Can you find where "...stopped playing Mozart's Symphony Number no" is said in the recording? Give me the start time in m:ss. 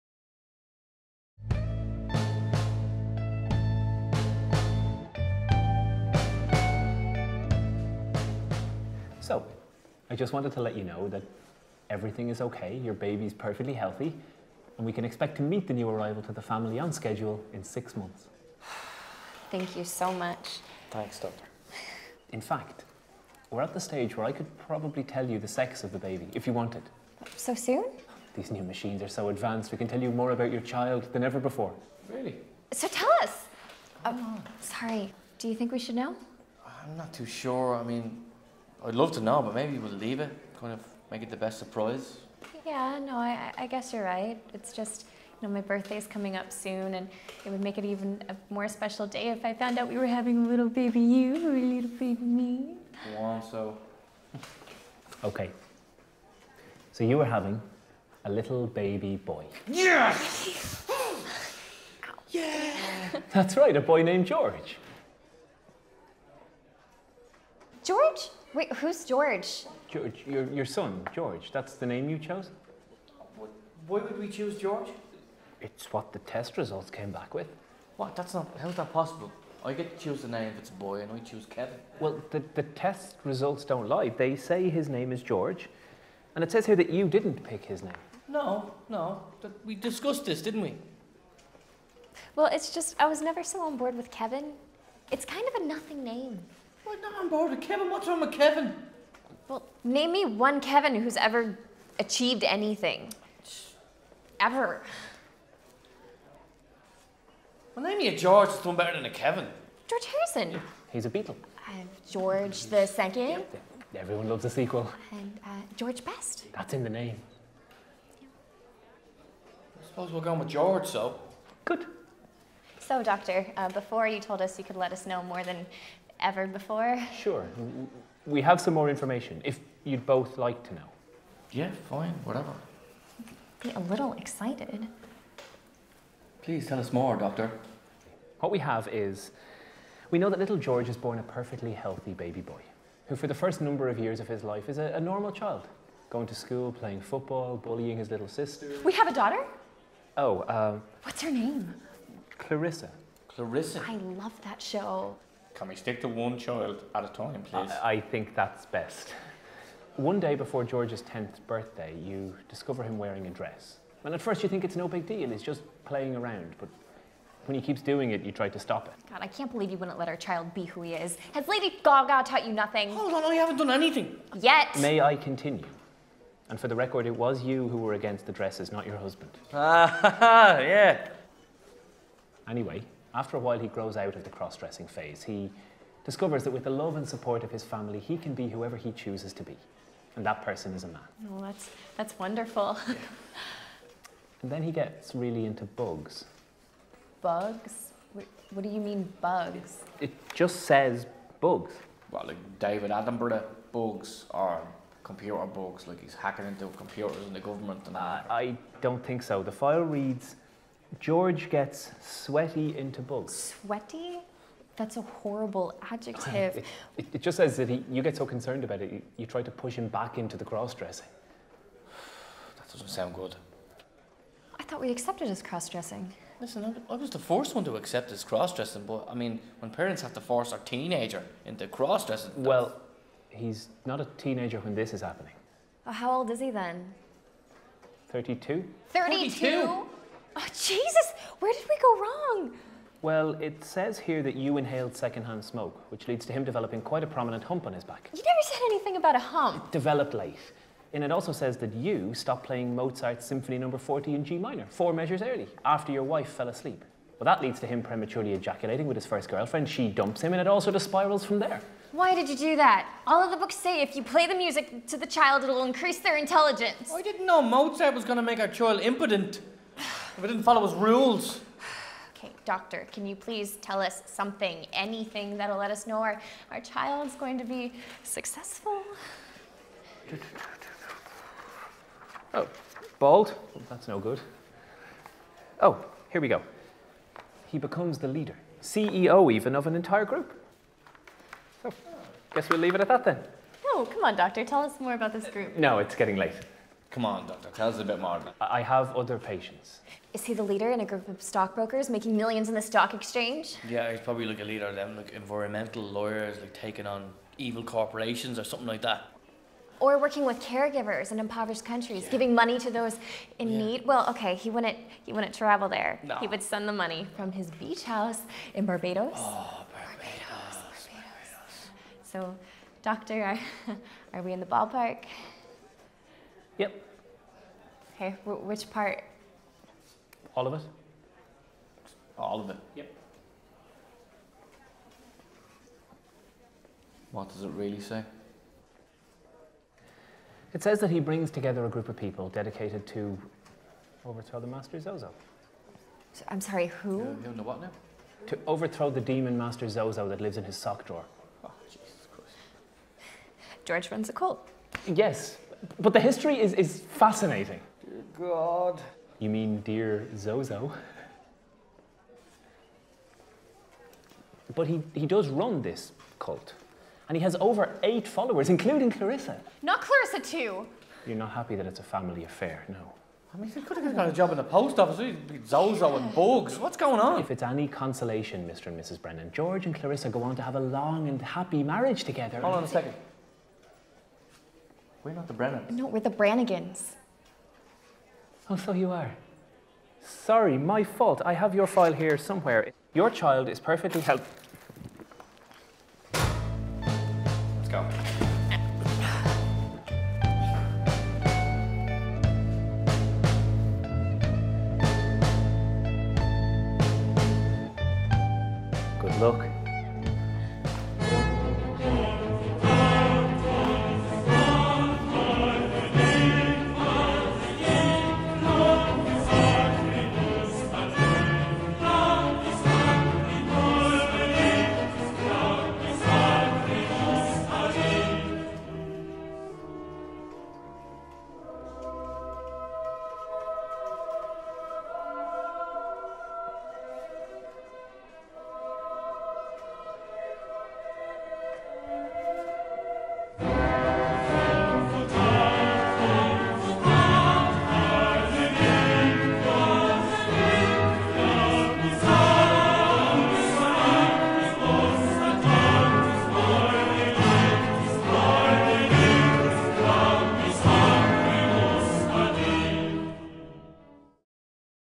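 4:12.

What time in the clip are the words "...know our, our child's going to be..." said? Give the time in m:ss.
4:35.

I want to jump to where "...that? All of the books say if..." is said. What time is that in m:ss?
4:22.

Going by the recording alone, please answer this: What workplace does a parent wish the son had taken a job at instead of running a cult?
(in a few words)
post office.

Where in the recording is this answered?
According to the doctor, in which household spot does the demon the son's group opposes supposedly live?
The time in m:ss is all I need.
5:50.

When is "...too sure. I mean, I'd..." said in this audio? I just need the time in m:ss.
0:37.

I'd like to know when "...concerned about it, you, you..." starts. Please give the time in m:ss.
3:38.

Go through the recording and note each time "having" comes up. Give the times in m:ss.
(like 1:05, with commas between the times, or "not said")
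0:50, 0:57.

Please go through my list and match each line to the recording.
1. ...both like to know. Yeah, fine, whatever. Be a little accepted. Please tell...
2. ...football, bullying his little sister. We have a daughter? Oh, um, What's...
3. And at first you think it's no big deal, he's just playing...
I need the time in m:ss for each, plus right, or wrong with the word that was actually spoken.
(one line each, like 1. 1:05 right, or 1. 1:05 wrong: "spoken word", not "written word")
1. 2:10 wrong: "excited", not "accepted"
2. 2:27 right
3. 2:44 right.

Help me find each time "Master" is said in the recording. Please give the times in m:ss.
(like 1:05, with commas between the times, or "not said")
5:44, 5:49.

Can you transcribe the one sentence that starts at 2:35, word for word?
Can we stick to one child at a time, please?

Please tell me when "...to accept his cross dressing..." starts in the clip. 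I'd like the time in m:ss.
3:47.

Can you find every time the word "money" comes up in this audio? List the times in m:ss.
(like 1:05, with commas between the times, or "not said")
5:12, 5:16.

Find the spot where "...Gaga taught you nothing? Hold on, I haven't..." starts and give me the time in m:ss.
2:51.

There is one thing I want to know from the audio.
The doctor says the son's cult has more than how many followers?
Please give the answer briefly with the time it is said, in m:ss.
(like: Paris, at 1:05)
8, at 6:07.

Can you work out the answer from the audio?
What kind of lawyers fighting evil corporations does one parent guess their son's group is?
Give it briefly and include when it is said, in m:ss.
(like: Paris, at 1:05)
environmental lawyers, at 5:05.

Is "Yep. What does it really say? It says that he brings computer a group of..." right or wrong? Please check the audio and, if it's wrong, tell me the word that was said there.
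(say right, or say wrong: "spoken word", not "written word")
wrong: "together", not "computer".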